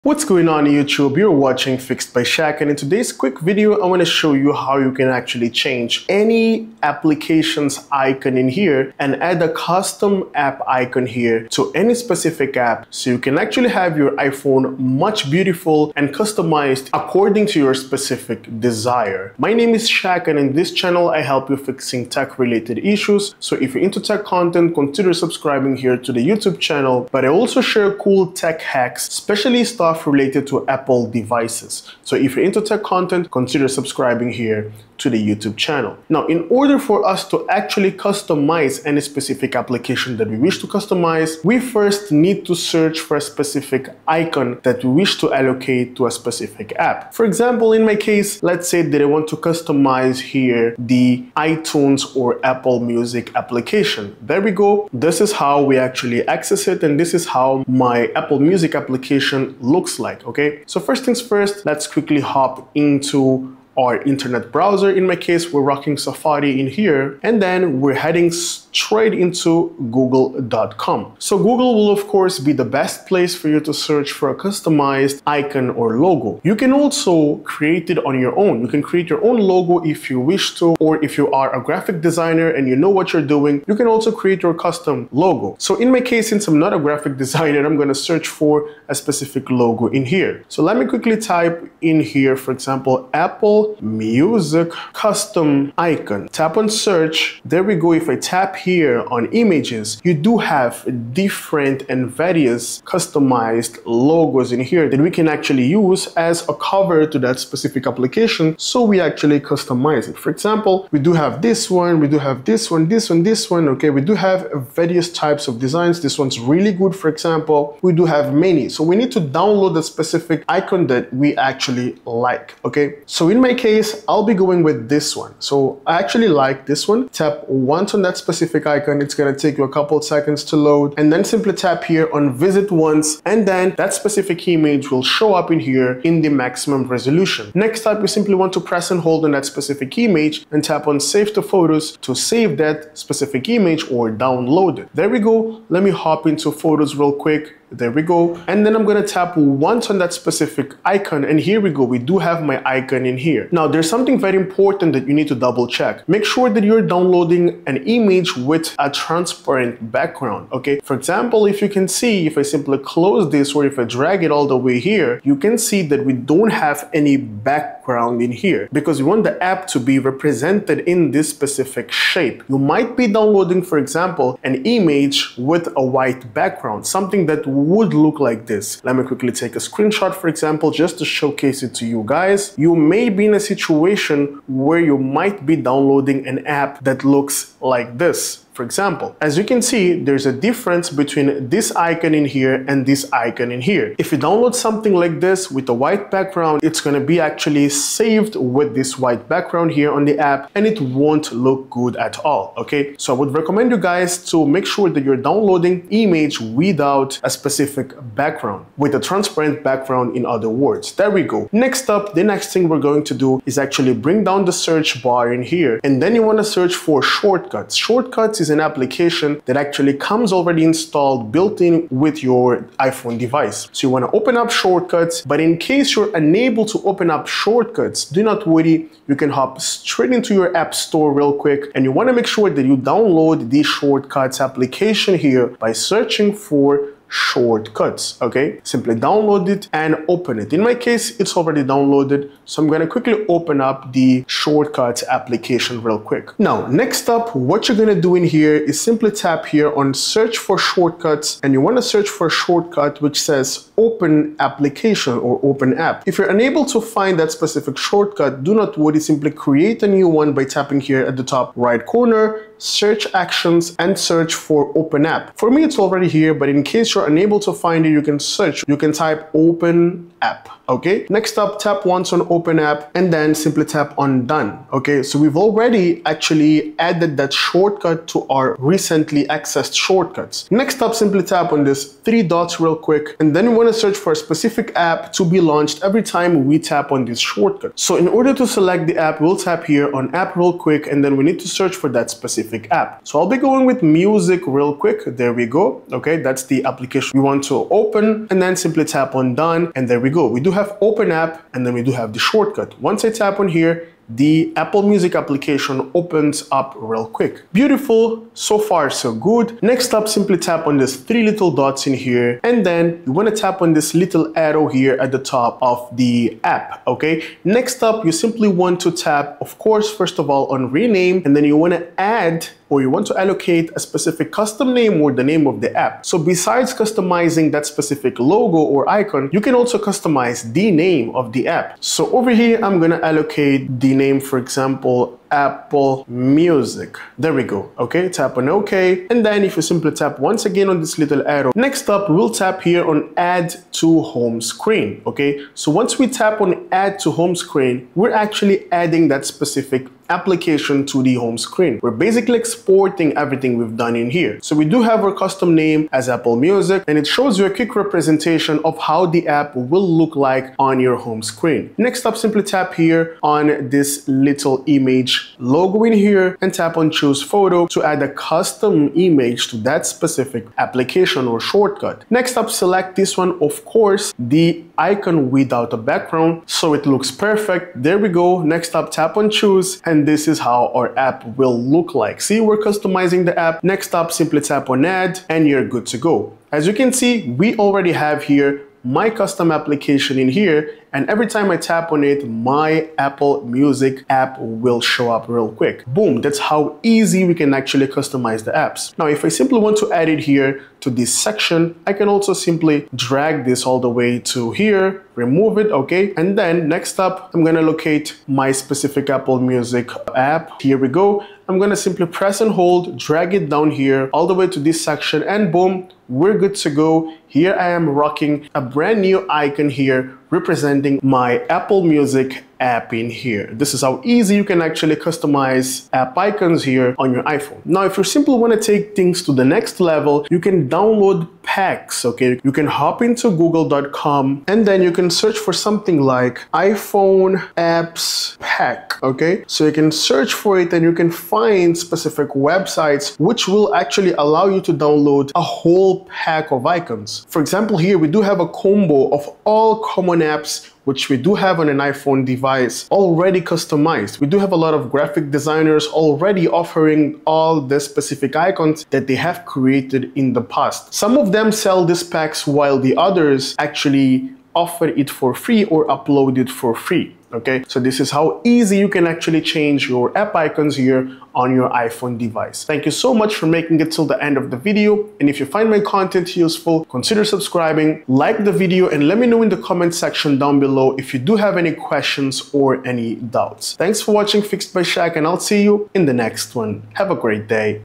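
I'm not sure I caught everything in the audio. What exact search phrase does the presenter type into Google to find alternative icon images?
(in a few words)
Apple Music Custom icon.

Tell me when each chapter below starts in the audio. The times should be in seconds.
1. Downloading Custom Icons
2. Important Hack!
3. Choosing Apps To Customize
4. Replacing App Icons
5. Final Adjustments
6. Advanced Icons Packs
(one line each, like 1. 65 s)
1. 40 s
2. 152 s
3. 210 s
4. 340 s
5. 398 s
6. 425 s.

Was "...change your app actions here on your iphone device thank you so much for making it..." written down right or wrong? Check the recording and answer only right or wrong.
wrong.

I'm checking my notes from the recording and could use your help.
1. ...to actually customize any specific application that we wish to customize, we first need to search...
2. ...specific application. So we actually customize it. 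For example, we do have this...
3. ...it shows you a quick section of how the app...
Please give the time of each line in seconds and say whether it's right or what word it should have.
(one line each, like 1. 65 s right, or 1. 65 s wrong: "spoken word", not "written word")
1. 37 s right
2. 107 s right
3. 356 s wrong: "representation", not "section".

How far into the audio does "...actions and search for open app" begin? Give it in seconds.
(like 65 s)
263 s.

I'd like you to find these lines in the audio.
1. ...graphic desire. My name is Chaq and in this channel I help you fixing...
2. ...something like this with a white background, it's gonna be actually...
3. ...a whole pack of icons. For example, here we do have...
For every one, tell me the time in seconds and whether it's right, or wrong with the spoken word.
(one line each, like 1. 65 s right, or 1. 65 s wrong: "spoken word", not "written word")
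1. 17 s wrong: "specific", not "graphic"
2. 194 s right
3. 445 s right.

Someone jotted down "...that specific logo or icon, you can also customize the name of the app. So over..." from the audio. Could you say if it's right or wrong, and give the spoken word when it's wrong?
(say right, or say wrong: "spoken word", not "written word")
right.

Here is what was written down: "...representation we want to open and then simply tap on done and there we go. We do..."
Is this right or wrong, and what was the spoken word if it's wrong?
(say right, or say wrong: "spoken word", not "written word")
wrong: "application", not "representation".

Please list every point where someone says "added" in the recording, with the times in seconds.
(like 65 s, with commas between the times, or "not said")
276 s.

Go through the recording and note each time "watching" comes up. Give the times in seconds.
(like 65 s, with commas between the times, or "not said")
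1 s, 484 s.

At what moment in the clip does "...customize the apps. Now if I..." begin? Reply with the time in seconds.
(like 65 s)
397 s.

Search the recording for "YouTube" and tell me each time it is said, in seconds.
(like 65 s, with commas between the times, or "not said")
0 s, 26 s, 35 s.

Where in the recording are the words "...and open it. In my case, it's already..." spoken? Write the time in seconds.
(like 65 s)
239 s.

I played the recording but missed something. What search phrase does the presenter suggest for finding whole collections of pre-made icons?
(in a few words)
iPhone apps pack.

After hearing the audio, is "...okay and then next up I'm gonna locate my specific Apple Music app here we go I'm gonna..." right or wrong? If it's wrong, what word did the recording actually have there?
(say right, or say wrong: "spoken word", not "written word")
right.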